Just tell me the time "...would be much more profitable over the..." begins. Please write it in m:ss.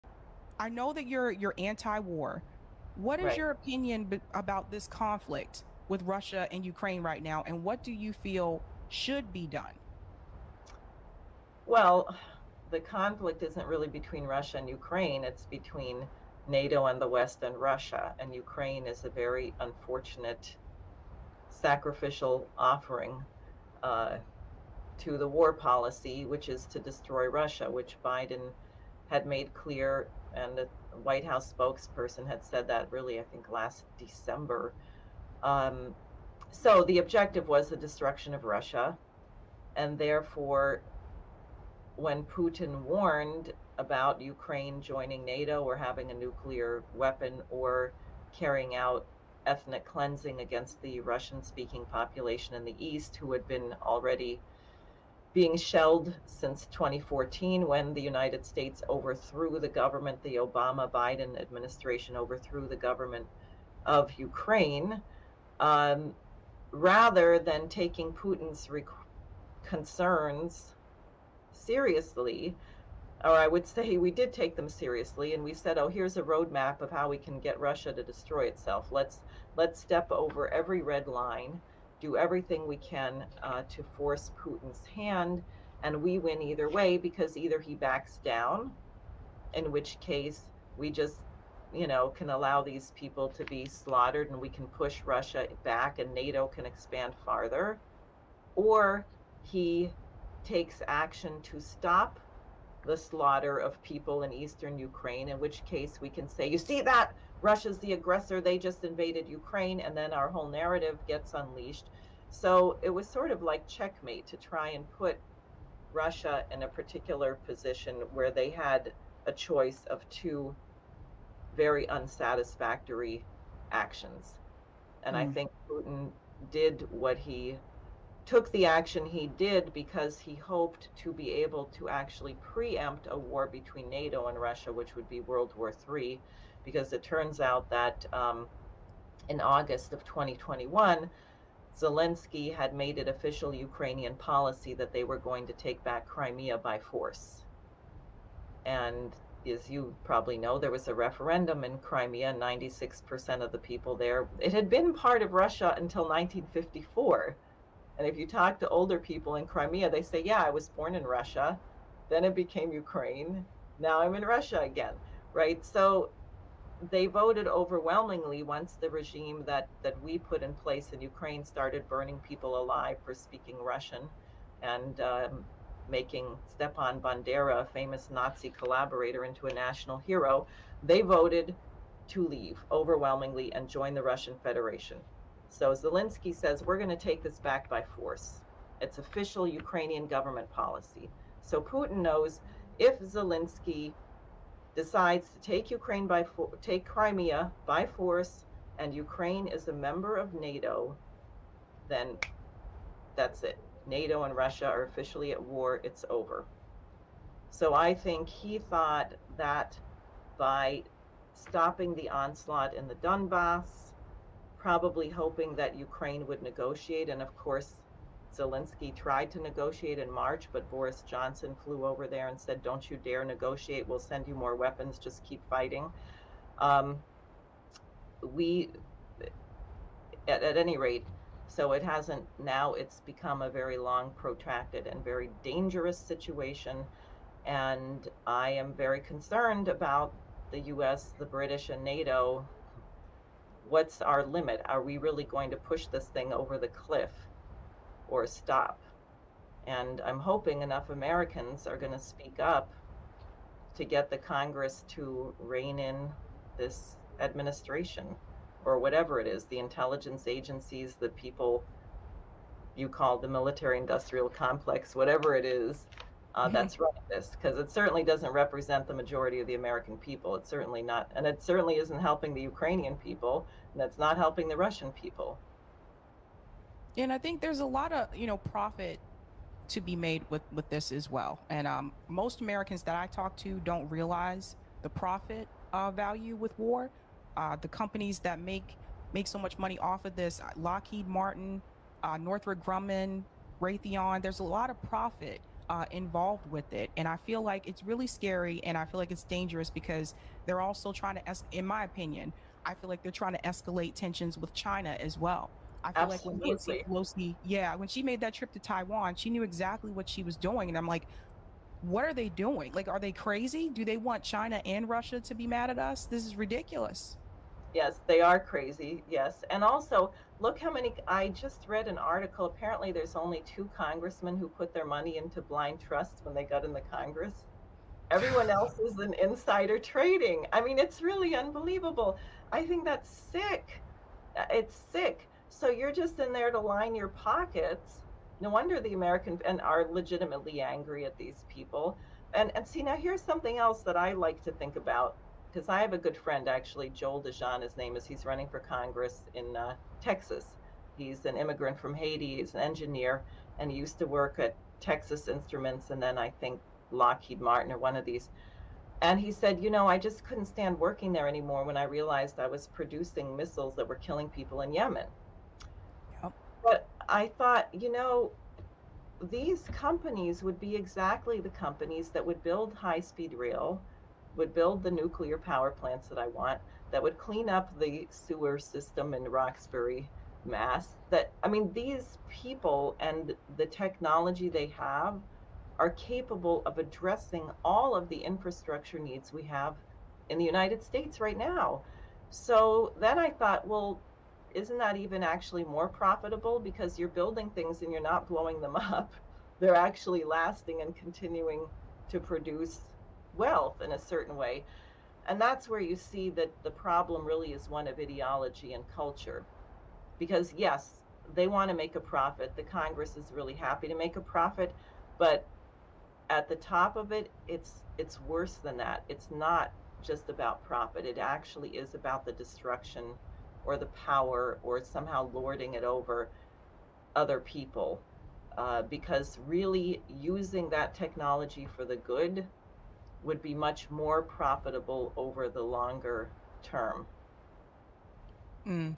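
7:13.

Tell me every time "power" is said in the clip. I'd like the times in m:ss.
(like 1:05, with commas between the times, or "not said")
6:15, 7:03.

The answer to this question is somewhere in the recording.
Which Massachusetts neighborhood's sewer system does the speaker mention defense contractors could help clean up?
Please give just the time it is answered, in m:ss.
6:19.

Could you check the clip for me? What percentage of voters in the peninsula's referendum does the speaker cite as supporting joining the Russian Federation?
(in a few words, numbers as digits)
96%.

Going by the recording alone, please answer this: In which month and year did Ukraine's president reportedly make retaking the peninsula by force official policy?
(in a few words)
August 2021.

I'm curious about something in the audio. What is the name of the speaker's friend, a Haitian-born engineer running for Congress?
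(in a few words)
Joel DeJean.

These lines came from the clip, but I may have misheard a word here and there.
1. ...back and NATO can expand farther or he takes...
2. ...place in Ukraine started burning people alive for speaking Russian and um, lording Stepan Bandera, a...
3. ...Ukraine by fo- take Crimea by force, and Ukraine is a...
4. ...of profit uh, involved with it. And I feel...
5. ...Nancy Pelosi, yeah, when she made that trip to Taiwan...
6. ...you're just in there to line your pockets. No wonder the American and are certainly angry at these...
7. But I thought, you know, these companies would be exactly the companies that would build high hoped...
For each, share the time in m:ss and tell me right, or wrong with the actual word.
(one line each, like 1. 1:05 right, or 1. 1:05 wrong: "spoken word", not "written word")
1. 1:35 right
2. 2:50 wrong: "making", not "lording"
3. 3:15 right
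4. 4:54 right
5. 5:06 right
6. 5:35 wrong: "legitimately", not "certainly"
7. 6:06 wrong: "speed", not "hoped".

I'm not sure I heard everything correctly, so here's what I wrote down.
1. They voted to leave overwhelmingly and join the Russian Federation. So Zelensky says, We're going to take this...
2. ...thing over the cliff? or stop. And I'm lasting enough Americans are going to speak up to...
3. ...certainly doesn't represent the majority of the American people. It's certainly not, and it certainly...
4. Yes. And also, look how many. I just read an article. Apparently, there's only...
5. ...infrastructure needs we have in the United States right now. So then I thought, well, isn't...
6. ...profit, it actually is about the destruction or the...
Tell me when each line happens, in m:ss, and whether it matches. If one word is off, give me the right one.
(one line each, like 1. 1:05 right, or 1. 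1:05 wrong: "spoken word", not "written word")
1. 3:00 right
2. 4:06 wrong: "hoping", not "lasting"
3. 4:27 right
4. 5:19 right
5. 6:28 right
6. 7:00 right.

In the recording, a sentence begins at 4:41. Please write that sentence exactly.
And um, most Americans that I talk to don't realize the profit uh, value with war.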